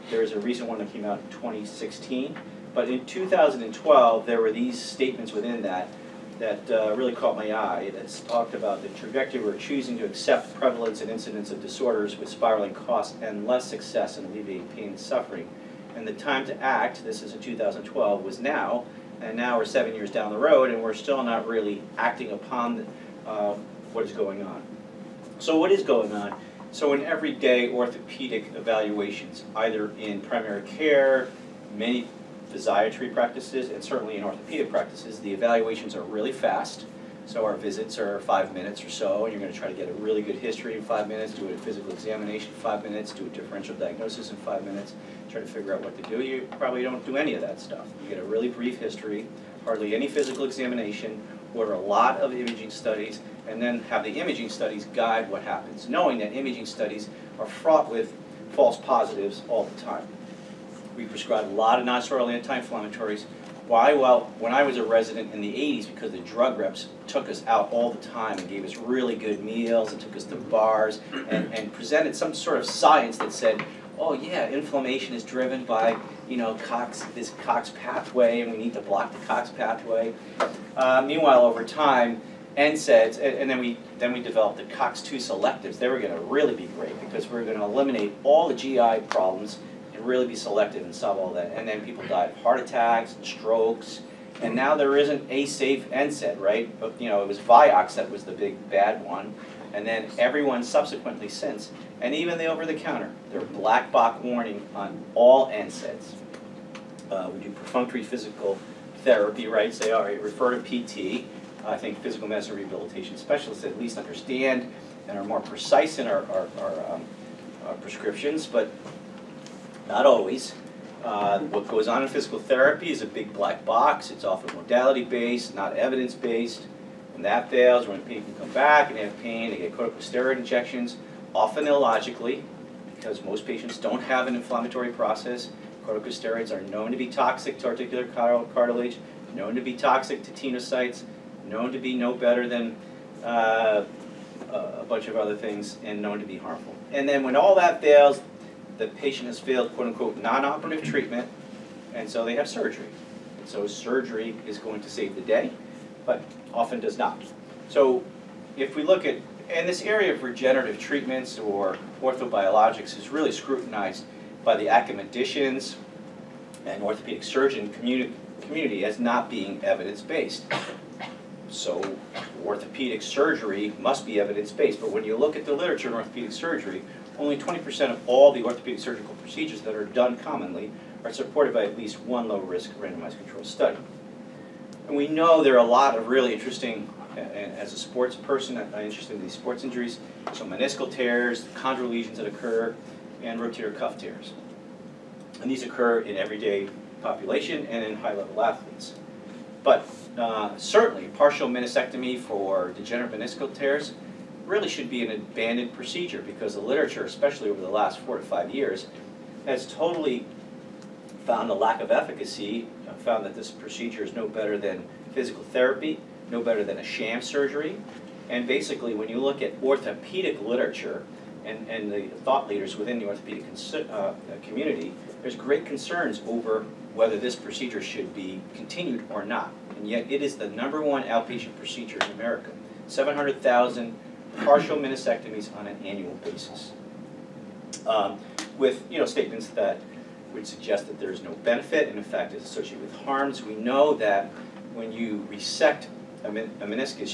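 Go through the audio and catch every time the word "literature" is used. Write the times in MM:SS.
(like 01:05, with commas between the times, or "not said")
02:55, 03:26, 03:40.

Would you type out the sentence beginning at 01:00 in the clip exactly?
We prescribed a lot of nonsteroidal anti-inflammatories.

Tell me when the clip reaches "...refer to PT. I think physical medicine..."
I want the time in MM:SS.
01:50.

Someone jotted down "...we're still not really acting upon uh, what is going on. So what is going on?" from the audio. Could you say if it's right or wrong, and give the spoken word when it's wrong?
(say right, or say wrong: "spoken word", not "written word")
right.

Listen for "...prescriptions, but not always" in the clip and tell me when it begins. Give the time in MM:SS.
01:57.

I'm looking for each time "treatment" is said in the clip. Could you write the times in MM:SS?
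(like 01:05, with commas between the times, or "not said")
02:30, 02:40.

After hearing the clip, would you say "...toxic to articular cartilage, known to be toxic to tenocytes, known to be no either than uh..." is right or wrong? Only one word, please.
wrong.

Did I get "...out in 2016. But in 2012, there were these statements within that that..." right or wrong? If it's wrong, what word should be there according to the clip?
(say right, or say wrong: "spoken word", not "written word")
right.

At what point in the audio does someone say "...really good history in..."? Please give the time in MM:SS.
00:39.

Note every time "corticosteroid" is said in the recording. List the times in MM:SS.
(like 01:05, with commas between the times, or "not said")
02:09, 02:15.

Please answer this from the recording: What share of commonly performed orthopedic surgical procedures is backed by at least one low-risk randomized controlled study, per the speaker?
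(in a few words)
20%.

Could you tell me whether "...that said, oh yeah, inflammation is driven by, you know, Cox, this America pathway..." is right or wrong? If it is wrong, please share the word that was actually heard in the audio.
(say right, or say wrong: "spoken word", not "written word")
wrong: "Cox", not "America".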